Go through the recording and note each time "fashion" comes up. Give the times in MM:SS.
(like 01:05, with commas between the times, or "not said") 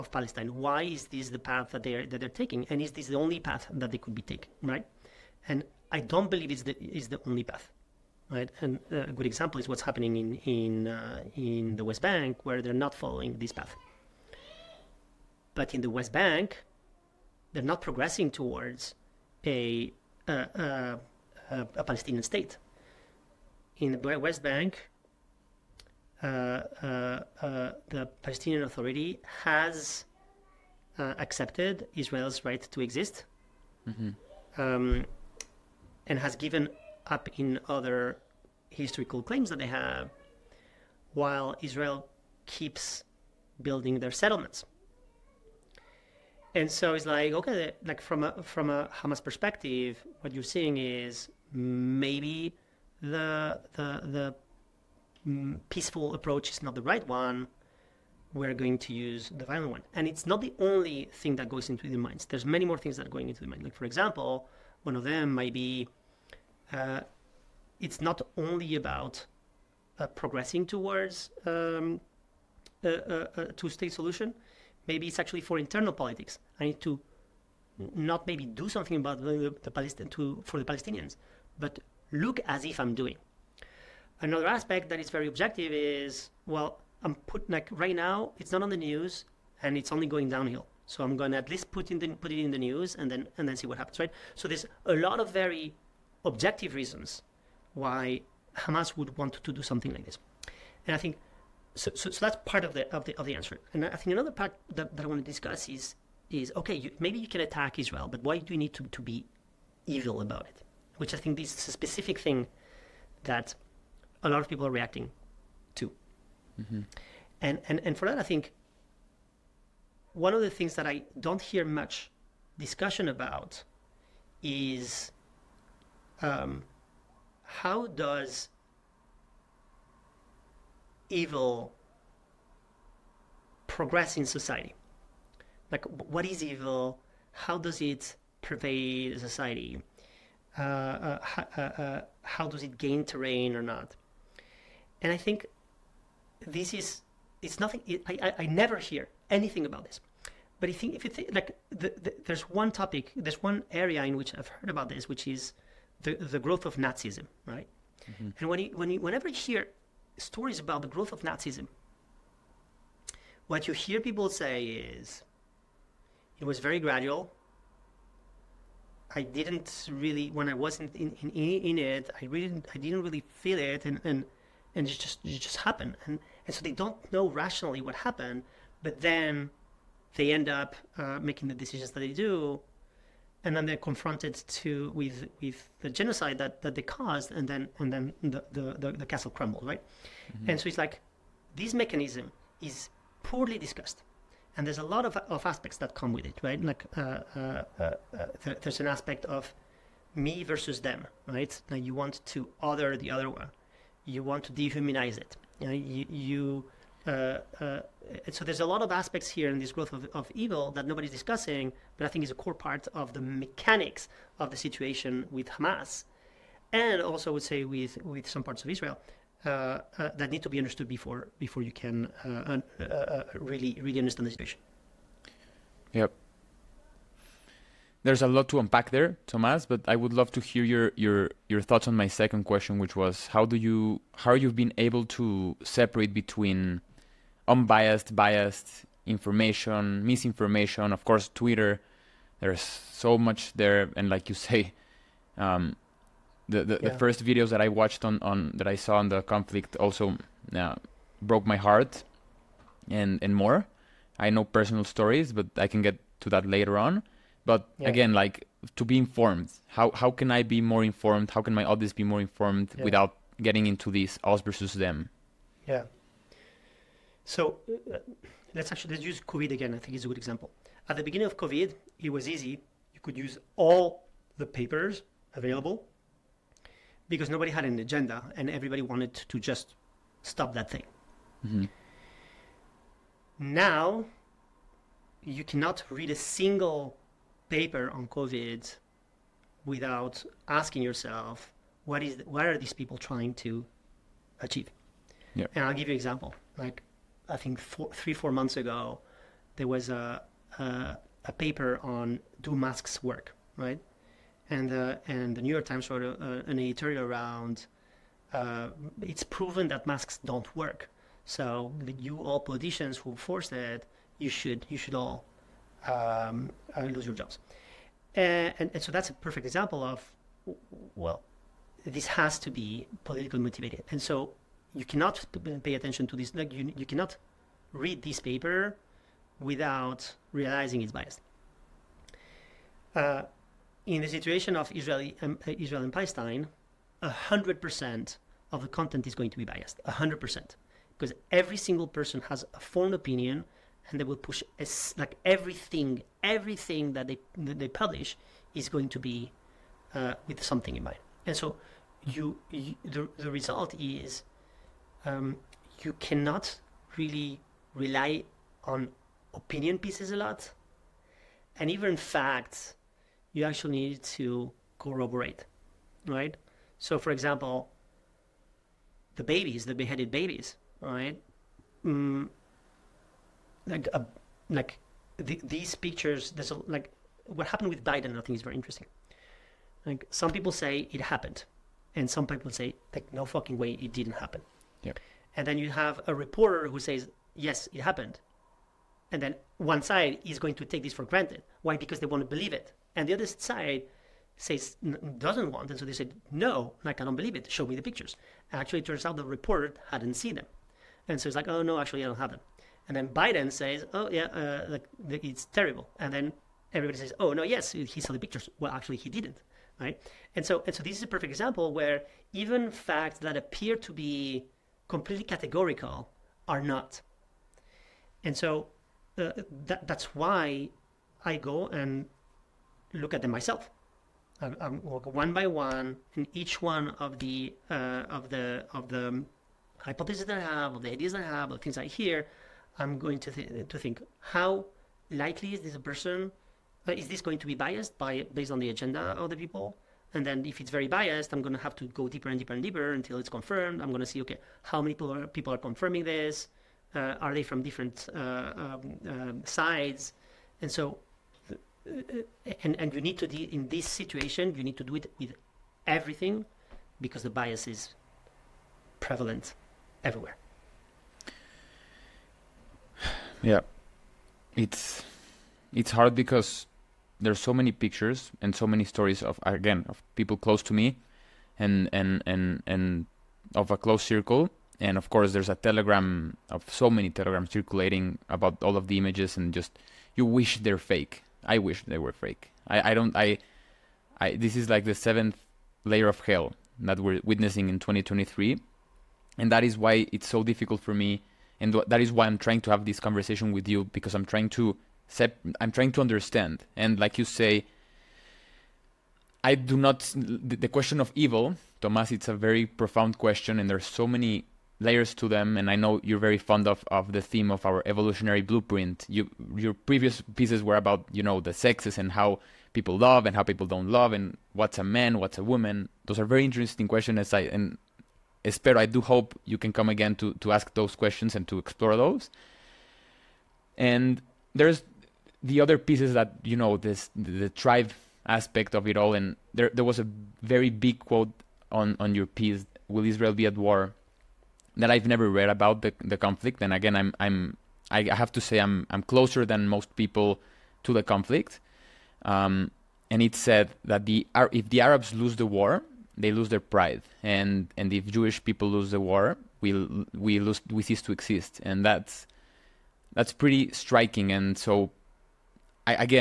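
not said.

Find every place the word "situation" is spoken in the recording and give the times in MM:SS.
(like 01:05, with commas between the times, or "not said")
03:34, 03:44, 05:34, 07:33.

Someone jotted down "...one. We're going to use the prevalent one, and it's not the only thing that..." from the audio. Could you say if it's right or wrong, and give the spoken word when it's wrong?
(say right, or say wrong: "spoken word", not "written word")
wrong: "violent", not "prevalent".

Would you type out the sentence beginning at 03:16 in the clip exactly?
Like uh, uh, uh, uh th- there's an aspect of me versus them, right?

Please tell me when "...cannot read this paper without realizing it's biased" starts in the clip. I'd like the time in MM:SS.
05:26.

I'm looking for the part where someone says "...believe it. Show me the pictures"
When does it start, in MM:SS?
06:37.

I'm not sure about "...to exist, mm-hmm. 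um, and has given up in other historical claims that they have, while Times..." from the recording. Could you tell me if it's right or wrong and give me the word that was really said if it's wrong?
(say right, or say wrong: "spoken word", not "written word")
wrong: "Israel", not "Times".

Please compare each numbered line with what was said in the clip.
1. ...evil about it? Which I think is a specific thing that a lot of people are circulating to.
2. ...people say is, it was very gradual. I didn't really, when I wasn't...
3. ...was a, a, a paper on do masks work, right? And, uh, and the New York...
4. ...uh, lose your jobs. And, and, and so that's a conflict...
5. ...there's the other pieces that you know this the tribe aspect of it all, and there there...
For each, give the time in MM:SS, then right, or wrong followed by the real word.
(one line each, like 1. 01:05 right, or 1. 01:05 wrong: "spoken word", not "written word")
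1. 01:49 wrong: "reacting", not "circulating"
2. 02:43 right
3. 04:59 right
4. 05:16 wrong: "perfect", not "conflict"
5. 08:44 right.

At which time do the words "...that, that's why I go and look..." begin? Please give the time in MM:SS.
06:59.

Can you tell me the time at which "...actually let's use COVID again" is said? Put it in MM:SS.
04:28.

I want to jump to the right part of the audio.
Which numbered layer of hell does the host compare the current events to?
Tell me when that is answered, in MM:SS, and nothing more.
08:04.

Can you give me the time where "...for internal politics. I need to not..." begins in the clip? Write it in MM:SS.
01:15.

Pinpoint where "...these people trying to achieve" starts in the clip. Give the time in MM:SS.
04:52.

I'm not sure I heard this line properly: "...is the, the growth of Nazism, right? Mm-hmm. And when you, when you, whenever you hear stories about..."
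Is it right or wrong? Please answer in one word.
right.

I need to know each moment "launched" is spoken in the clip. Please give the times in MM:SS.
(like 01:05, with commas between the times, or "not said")
not said.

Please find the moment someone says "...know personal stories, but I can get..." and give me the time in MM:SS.
04:14.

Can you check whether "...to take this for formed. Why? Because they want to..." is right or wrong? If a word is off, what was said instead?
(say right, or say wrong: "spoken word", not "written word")
wrong: "granted", not "formed".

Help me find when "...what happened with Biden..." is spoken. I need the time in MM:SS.
06:17.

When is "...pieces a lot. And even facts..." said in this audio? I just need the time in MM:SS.
05:59.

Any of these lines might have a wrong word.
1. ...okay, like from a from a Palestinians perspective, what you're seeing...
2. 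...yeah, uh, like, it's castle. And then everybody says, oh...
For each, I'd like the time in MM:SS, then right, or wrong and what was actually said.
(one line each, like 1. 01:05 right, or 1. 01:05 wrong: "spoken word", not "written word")
1. 00:47 wrong: "Hamas", not "Palestinians"
2. 06:44 wrong: "terrible", not "castle".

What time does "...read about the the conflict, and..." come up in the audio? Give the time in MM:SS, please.
08:55.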